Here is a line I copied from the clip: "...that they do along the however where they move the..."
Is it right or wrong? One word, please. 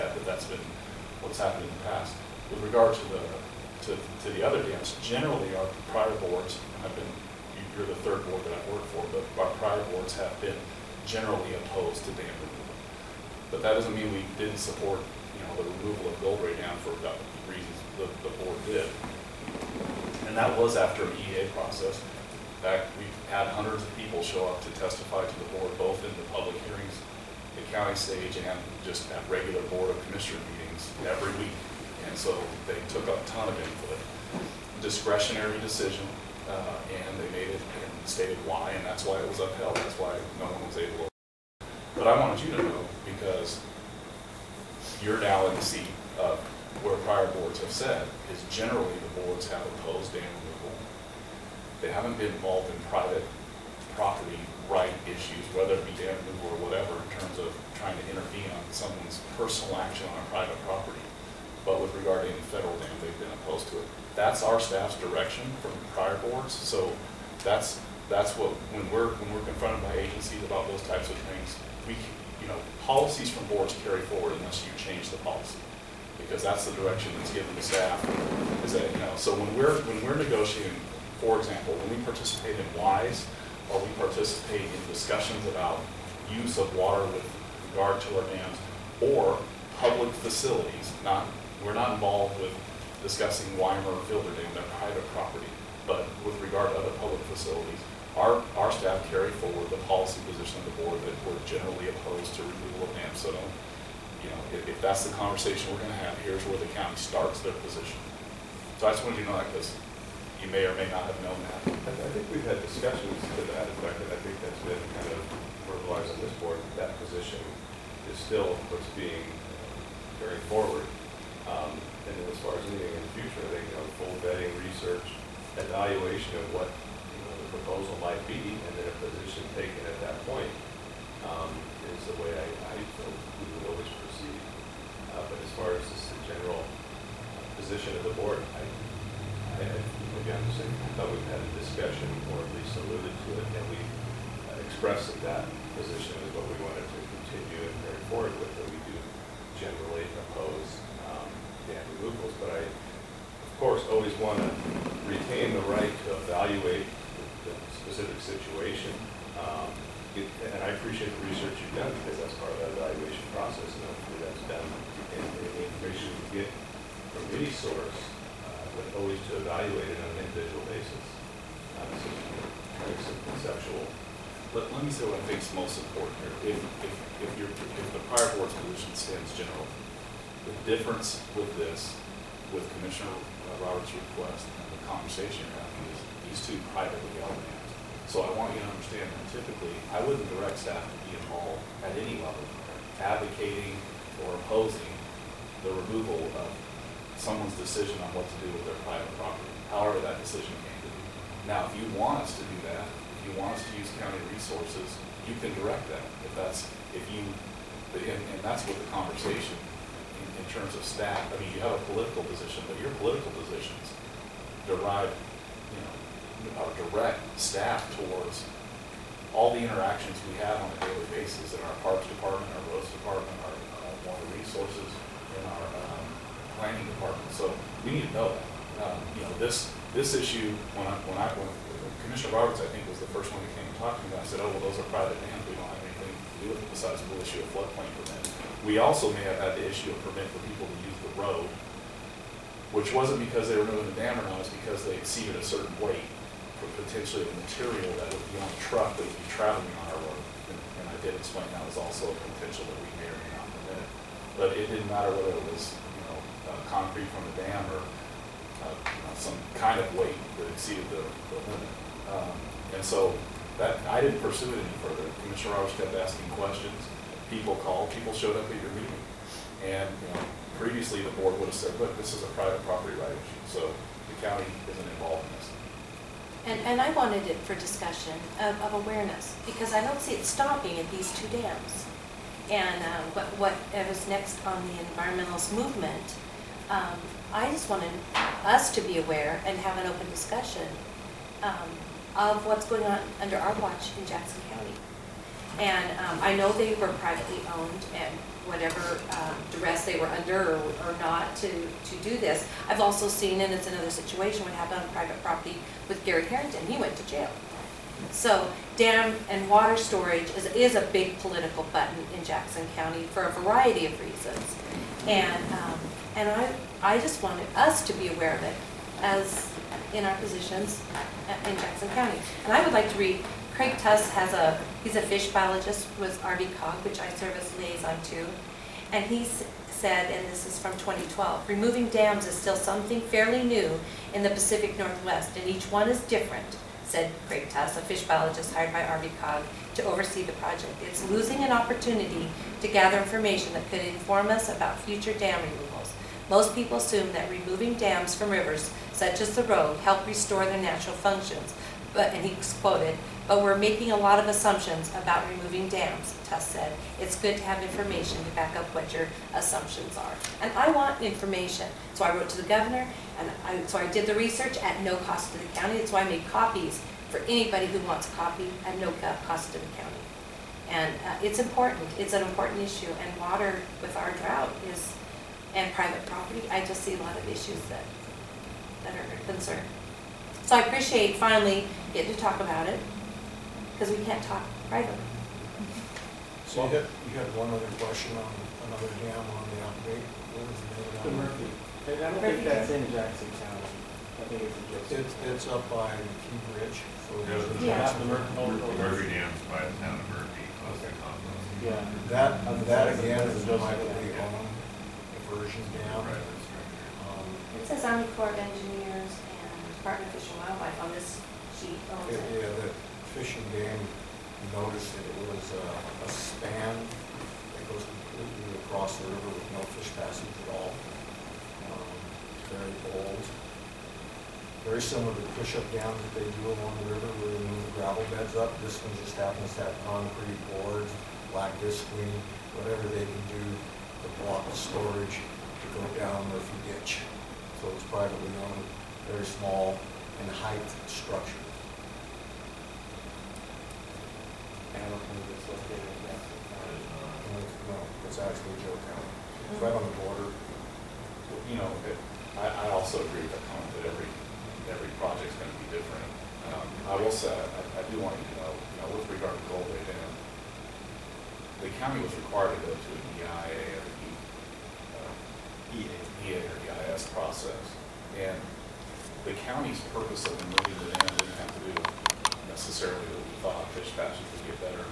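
wrong.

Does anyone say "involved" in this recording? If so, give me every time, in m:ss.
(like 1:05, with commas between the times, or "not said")
0:52, 1:31, 3:11, 4:34.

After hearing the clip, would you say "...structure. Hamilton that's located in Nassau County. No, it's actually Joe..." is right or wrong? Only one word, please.
right.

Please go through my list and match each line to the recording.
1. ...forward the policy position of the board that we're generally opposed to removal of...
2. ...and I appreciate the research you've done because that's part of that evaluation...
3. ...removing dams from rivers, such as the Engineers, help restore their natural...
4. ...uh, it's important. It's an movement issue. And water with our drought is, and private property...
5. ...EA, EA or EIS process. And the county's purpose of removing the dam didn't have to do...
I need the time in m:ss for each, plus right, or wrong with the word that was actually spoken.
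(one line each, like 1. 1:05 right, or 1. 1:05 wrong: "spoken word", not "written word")
1. 1:39 right
2. 2:40 right
3. 5:47 wrong: "Rogue", not "Engineers"
4. 6:11 wrong: "important", not "movement"
5. 7:45 right.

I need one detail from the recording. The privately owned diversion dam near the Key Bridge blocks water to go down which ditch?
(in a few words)
Murphy Ditch.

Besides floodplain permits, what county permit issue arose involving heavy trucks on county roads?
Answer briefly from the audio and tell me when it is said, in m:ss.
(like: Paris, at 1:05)
permit for people to use the road, at 4:00.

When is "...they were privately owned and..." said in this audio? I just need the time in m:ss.
4:56.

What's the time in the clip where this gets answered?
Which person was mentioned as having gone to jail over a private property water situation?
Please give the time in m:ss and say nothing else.
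5:06.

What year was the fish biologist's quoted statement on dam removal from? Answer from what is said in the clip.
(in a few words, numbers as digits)
2012.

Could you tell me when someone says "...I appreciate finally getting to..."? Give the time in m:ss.
6:20.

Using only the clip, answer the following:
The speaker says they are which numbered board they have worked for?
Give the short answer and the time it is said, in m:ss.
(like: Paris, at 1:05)
third, at 0:08.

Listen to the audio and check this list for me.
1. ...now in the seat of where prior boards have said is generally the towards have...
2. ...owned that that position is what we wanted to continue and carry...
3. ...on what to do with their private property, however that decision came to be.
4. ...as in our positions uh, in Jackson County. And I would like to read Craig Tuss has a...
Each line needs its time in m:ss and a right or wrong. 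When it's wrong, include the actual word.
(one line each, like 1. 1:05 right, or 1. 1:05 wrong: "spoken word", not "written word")
1. 0:45 wrong: "boards", not "towards"
2. 2:24 wrong: "expressed", not "owned"
3. 3:18 right
4. 5:19 right.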